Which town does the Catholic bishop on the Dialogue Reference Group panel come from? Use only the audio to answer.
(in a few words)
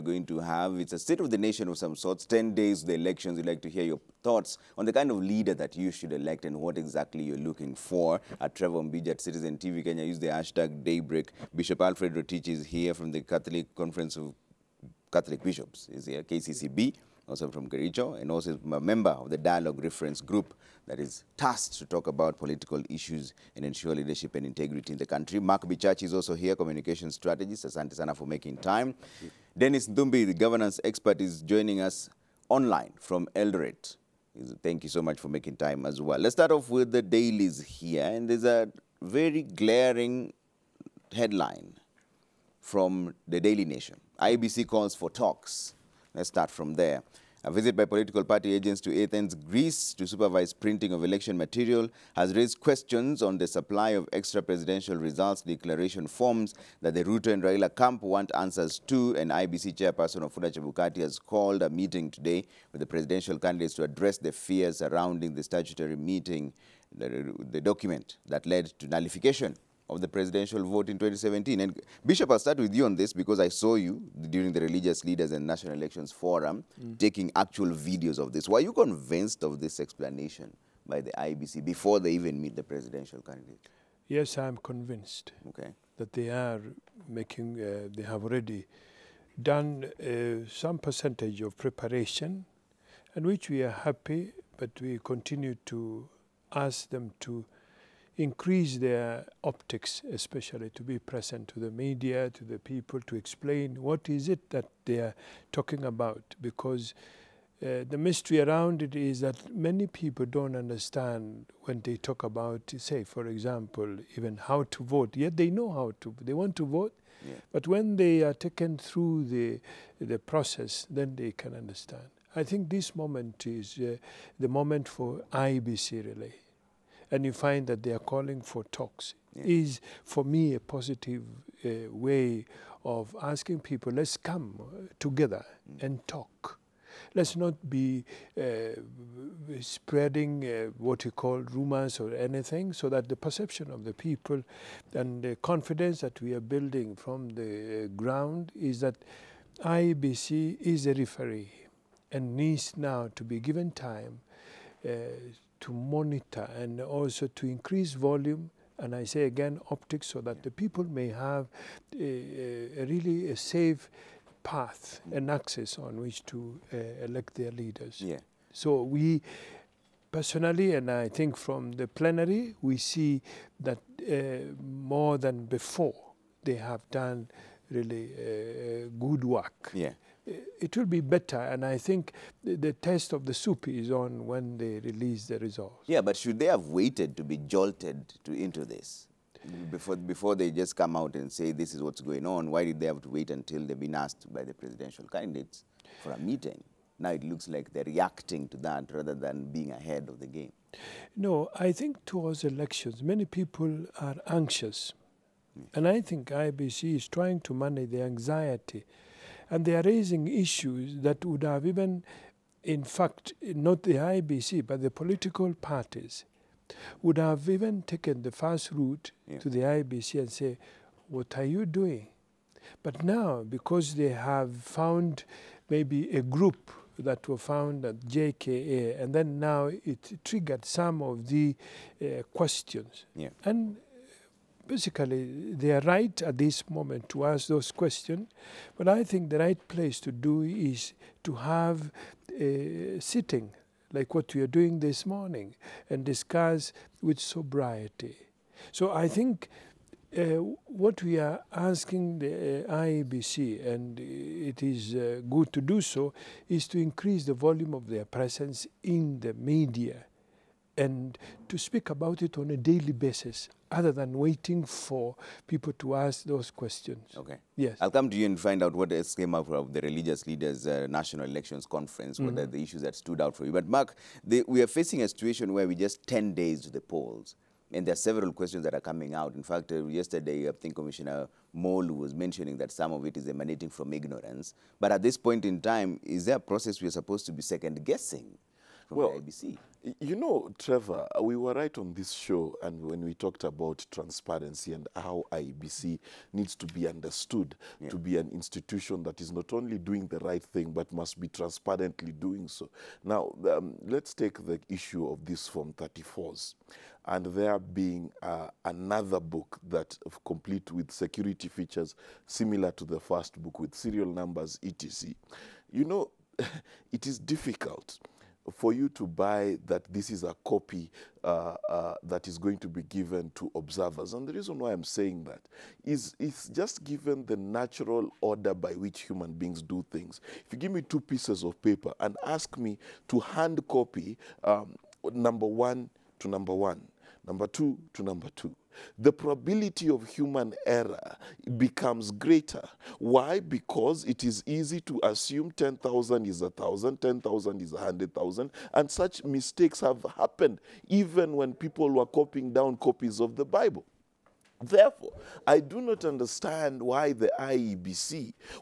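Kericho.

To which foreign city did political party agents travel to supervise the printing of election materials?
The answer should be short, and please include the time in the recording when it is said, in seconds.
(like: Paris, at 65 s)
Athens, Greece, at 49 s.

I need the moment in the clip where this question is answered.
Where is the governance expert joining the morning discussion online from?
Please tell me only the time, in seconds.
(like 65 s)
33 s.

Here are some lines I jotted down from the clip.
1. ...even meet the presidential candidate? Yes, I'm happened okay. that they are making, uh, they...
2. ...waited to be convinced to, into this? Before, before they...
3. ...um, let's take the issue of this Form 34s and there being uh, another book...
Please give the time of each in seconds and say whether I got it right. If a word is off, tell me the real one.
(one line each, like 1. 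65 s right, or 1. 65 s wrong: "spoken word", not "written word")
1. 82 s wrong: "convinced", not "happened"
2. 186 s wrong: "jolted", not "convinced"
3. 303 s right.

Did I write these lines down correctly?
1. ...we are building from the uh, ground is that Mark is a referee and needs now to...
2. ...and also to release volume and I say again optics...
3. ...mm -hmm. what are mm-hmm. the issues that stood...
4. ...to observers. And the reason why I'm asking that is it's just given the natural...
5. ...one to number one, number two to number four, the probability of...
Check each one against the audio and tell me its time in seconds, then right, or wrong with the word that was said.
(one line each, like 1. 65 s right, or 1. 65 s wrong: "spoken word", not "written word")
1. 146 s wrong: "IBC", not "Mark"
2. 156 s wrong: "increase", not "release"
3. 272 s right
4. 323 s wrong: "saying", not "asking"
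5. 335 s wrong: "two", not "four".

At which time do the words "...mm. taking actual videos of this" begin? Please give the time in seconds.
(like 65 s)
76 s.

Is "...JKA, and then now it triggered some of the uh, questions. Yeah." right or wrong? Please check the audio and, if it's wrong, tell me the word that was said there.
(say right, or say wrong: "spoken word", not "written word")
right.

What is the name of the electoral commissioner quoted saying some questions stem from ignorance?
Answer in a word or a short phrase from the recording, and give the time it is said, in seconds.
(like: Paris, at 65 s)
Molu, at 281 s.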